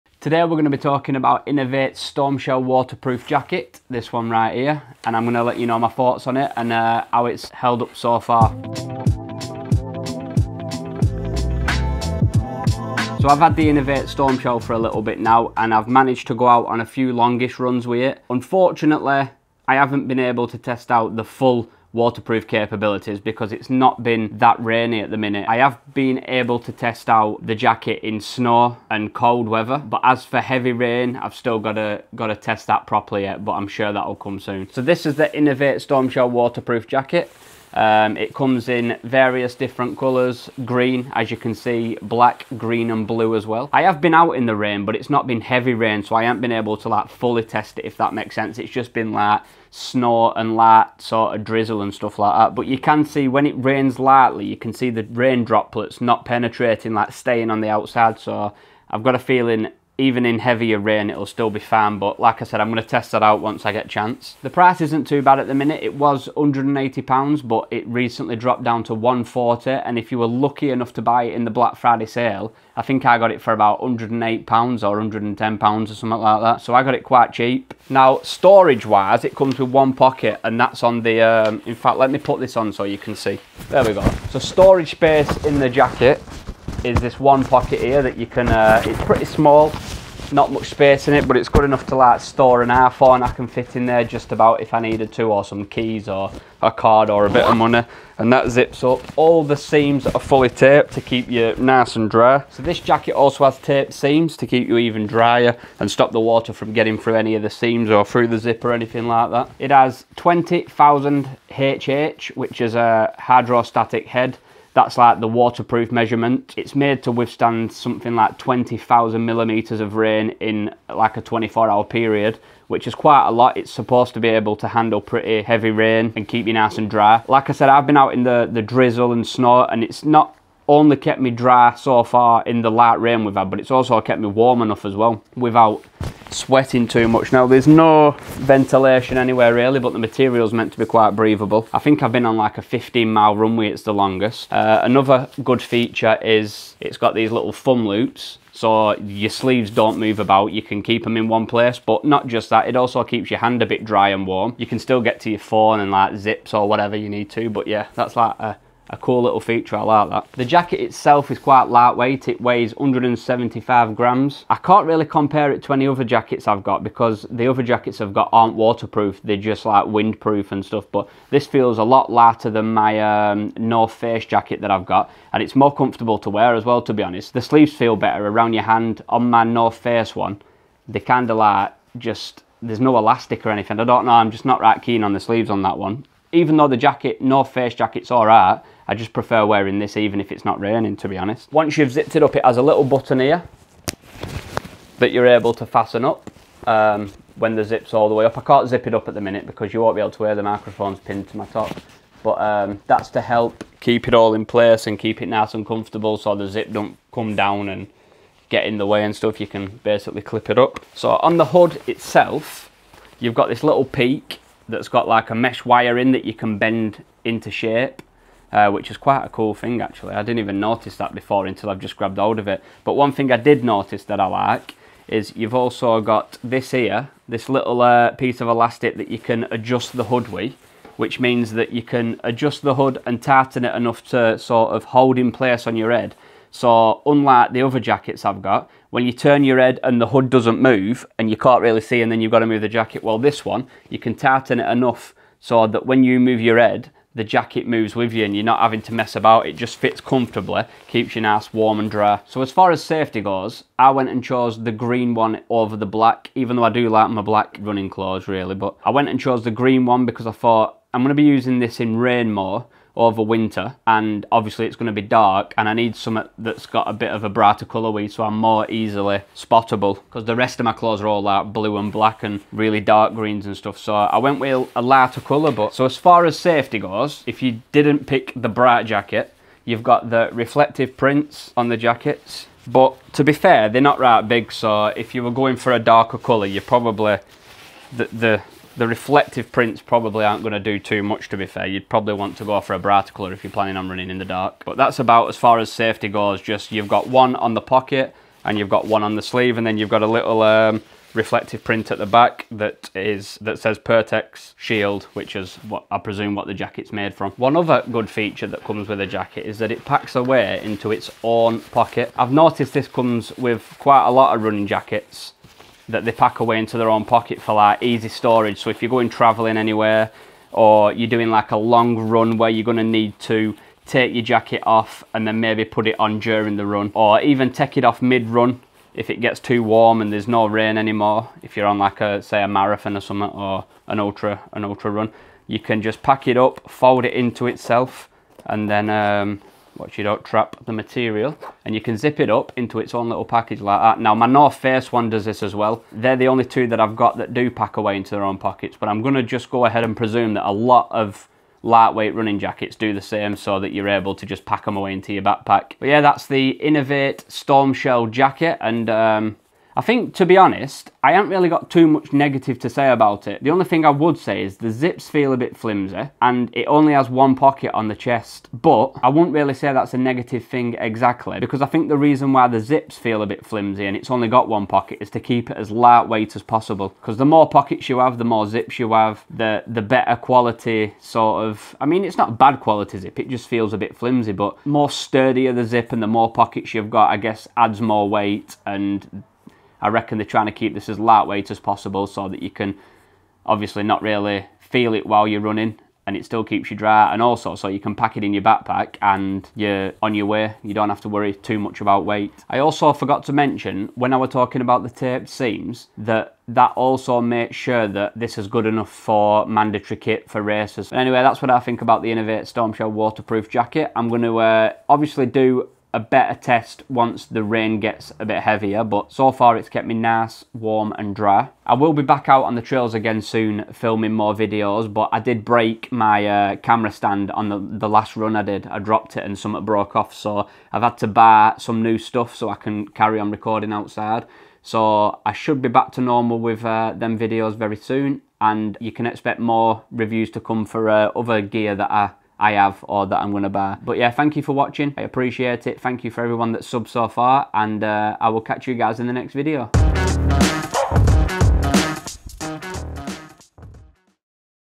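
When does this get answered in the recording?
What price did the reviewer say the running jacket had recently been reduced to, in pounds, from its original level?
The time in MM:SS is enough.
01:08.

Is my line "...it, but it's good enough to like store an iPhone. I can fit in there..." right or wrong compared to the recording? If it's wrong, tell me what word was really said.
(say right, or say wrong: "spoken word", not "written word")
right.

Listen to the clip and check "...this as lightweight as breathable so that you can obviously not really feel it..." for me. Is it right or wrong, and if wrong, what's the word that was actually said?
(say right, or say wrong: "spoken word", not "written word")
wrong: "possible", not "breathable".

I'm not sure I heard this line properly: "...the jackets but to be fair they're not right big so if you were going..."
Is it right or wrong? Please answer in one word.
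right.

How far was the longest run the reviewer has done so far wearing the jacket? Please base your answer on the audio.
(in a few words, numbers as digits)
15 miles.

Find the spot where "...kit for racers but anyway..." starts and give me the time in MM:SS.
06:49.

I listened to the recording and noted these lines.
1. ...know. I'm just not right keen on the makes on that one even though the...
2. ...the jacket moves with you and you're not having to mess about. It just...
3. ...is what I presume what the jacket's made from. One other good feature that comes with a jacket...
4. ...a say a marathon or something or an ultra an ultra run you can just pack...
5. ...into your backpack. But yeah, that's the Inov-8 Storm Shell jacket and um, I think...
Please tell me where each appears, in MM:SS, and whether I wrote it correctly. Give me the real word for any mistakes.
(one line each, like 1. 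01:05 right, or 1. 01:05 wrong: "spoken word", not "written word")
1. 03:04 wrong: "sleeves", not "makes"
2. 04:07 right
3. 05:05 right
4. 05:32 right
5. 05:54 right.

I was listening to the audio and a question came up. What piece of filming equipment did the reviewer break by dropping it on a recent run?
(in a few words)
camera stand.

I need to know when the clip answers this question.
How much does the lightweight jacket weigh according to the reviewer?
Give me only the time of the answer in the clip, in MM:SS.
02:42.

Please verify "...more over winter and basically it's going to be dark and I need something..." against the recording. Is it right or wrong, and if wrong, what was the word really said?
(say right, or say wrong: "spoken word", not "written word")
wrong: "obviously", not "basically".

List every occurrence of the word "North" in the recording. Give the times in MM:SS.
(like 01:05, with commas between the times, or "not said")
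02:53, 02:59, 03:07, 05:44.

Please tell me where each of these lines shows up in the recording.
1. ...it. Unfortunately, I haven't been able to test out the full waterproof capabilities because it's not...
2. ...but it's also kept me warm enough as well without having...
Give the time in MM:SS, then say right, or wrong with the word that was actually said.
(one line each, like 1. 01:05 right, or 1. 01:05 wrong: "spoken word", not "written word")
1. 00:18 right
2. 02:13 wrong: "sweating", not "having".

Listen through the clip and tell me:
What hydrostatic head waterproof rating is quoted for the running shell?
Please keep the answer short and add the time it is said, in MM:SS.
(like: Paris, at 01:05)
20,000, at 01:50.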